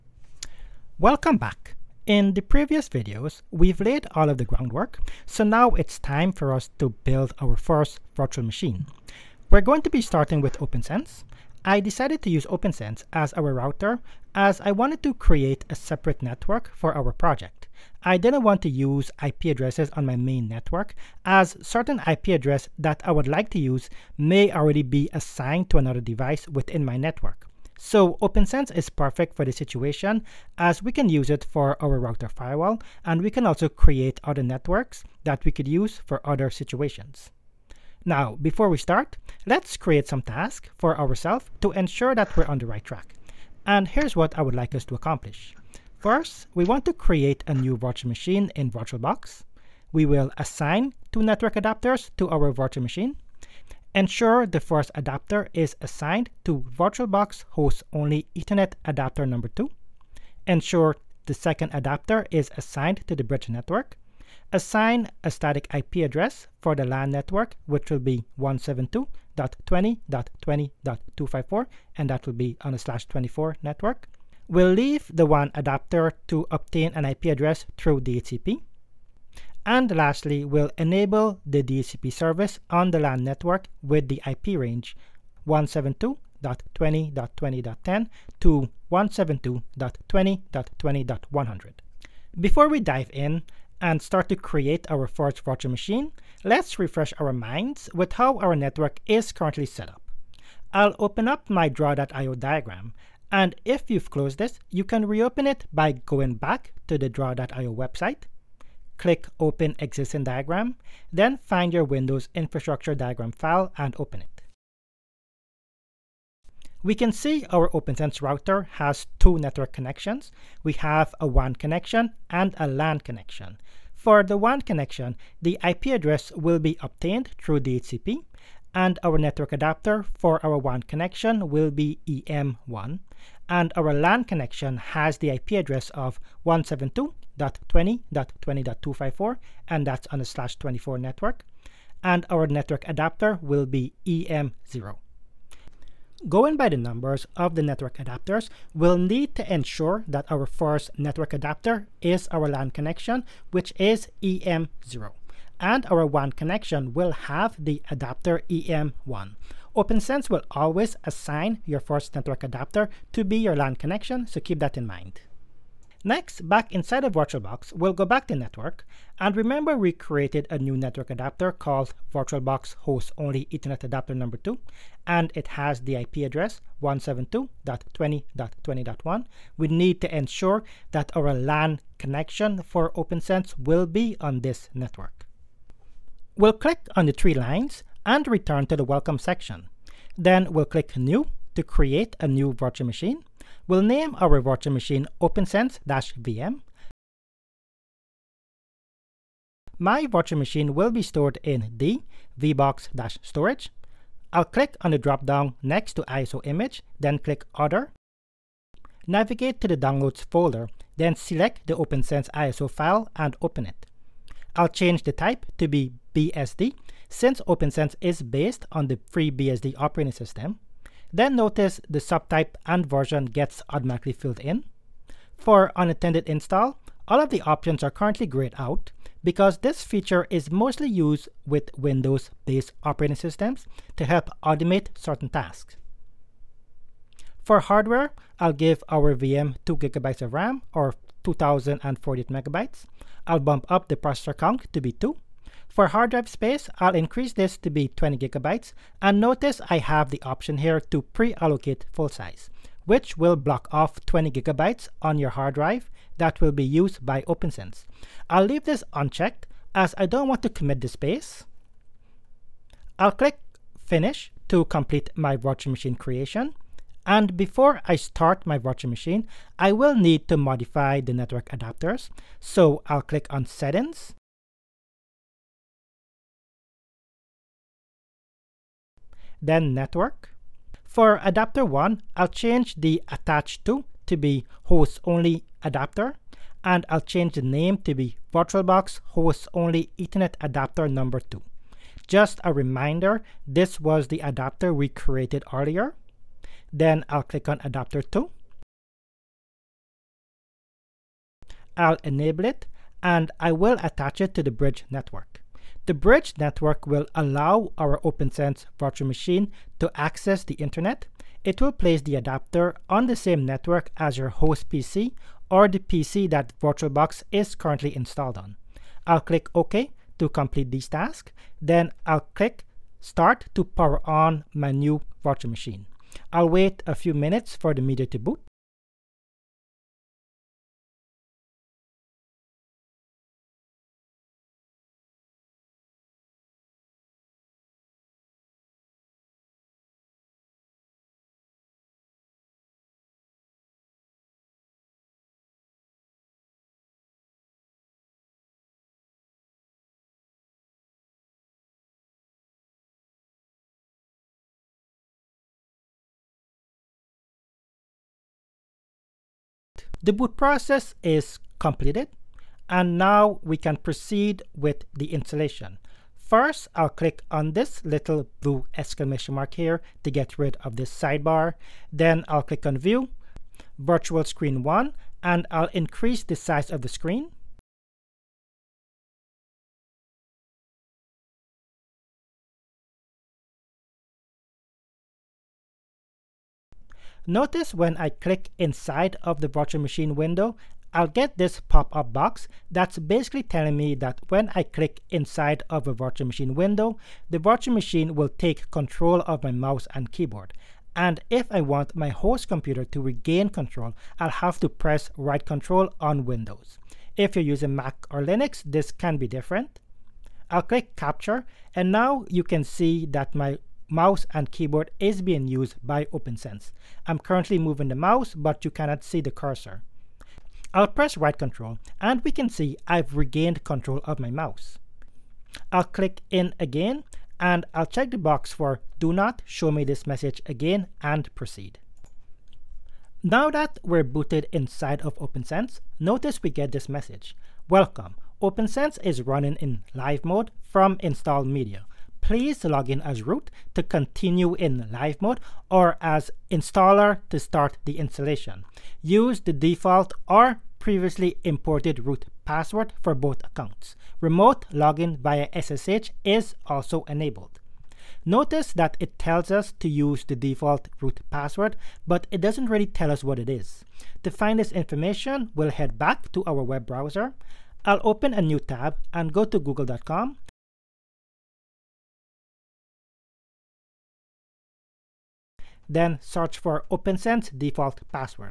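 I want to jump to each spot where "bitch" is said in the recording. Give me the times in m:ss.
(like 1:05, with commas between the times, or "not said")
not said.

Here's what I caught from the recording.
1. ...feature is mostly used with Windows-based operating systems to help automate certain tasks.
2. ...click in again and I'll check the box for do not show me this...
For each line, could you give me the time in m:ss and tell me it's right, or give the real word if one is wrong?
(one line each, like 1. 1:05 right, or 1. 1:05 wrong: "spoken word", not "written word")
1. 3:49 right
2. 7:05 right.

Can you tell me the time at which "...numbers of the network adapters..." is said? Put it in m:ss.
2:26.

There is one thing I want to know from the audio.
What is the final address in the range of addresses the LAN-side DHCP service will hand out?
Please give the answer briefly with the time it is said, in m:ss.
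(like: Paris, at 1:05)
172.20.20.100, at 1:28.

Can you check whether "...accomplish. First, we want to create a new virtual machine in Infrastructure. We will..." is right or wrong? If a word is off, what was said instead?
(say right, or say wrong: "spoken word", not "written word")
wrong: "VirtualBox", not "Infrastructure".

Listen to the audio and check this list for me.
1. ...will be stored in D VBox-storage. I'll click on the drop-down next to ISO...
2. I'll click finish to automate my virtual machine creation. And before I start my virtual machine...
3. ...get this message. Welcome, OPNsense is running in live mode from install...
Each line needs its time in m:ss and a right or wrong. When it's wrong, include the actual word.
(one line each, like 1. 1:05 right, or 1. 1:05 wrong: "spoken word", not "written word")
1. 3:20 right
2. 4:22 wrong: "complete", not "automate"
3. 7:16 right.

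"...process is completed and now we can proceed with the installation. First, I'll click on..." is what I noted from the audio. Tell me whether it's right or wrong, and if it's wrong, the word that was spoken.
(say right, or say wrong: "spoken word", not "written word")
right.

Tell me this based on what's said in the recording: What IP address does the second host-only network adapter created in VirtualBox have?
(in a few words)
172.20.20.1.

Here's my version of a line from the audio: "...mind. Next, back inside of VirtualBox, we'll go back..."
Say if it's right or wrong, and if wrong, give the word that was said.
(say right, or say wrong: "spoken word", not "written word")
right.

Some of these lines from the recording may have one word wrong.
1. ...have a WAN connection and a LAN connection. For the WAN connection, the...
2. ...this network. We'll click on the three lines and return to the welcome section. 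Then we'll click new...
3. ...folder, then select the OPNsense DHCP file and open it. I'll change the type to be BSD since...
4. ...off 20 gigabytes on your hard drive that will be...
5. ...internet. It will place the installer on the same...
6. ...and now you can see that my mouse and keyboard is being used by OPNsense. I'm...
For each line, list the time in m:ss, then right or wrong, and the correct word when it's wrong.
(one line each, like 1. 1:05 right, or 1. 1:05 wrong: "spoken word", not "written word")
1. 2:00 right
2. 3:04 right
3. 3:30 wrong: "ISO", not "DHCP"
4. 4:13 right
5. 5:10 wrong: "adapter", not "installer"
6. 6:51 right.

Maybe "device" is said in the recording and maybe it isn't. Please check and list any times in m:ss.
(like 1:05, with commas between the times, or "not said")
0:25.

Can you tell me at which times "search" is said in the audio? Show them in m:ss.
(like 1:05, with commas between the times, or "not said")
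7:56.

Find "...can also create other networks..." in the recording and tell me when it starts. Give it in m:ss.
0:33.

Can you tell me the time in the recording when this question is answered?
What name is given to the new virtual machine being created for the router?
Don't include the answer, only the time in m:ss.
3:15.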